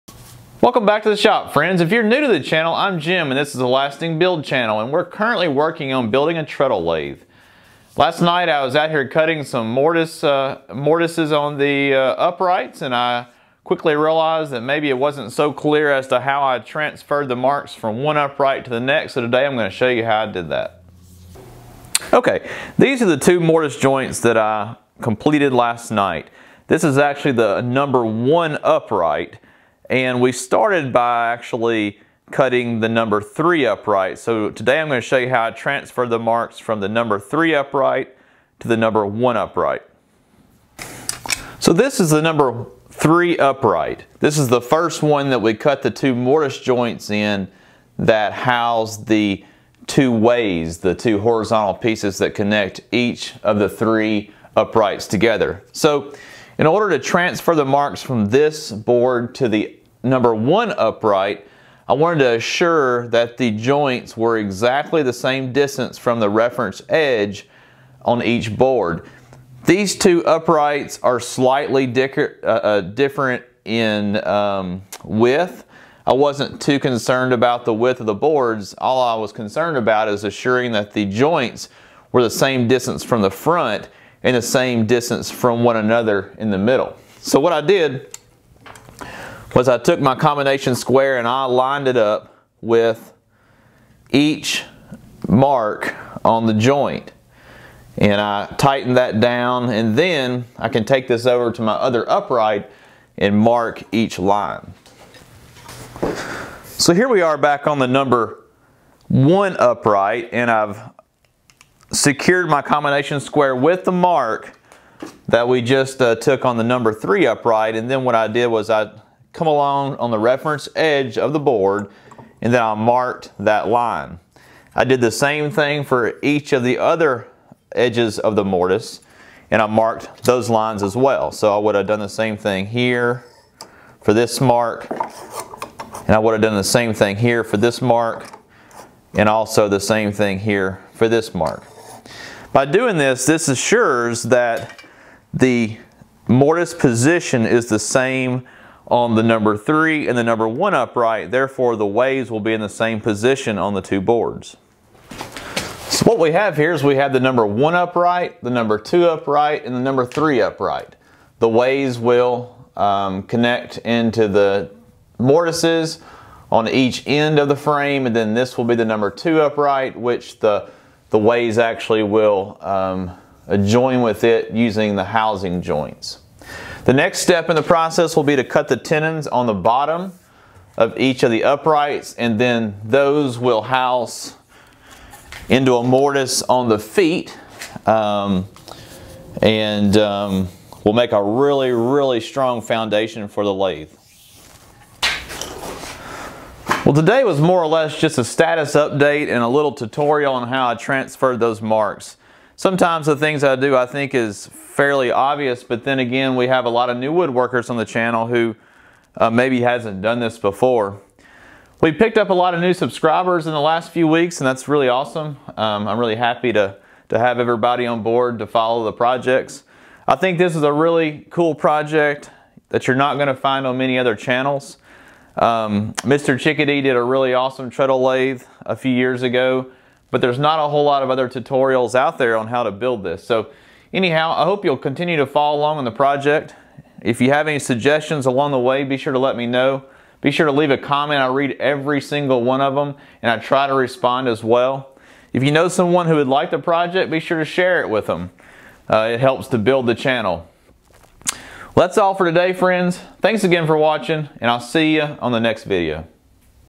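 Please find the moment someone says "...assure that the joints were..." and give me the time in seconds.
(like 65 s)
62 s.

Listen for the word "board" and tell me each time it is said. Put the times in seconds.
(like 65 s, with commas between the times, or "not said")
58 s, 68 s, 78 s, 121 s, 154 s, 218 s.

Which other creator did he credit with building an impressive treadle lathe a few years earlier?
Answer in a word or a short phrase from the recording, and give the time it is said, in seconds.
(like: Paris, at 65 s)
Mr. Chickadee, at 226 s.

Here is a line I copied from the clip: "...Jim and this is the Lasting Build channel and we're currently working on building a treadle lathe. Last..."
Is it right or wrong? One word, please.
right.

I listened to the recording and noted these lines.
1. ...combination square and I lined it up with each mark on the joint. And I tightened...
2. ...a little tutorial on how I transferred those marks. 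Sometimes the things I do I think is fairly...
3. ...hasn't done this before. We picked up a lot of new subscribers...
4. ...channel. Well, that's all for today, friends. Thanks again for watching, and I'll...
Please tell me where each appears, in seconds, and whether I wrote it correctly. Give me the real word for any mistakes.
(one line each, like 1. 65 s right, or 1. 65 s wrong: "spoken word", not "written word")
1. 90 s right
2. 199 s right
3. 209 s right
4. 249 s right.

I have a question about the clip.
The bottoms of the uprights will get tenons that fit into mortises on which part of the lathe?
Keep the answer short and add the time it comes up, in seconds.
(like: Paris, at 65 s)
The feet, at 186 s.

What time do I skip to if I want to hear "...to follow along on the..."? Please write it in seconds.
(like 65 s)
235 s.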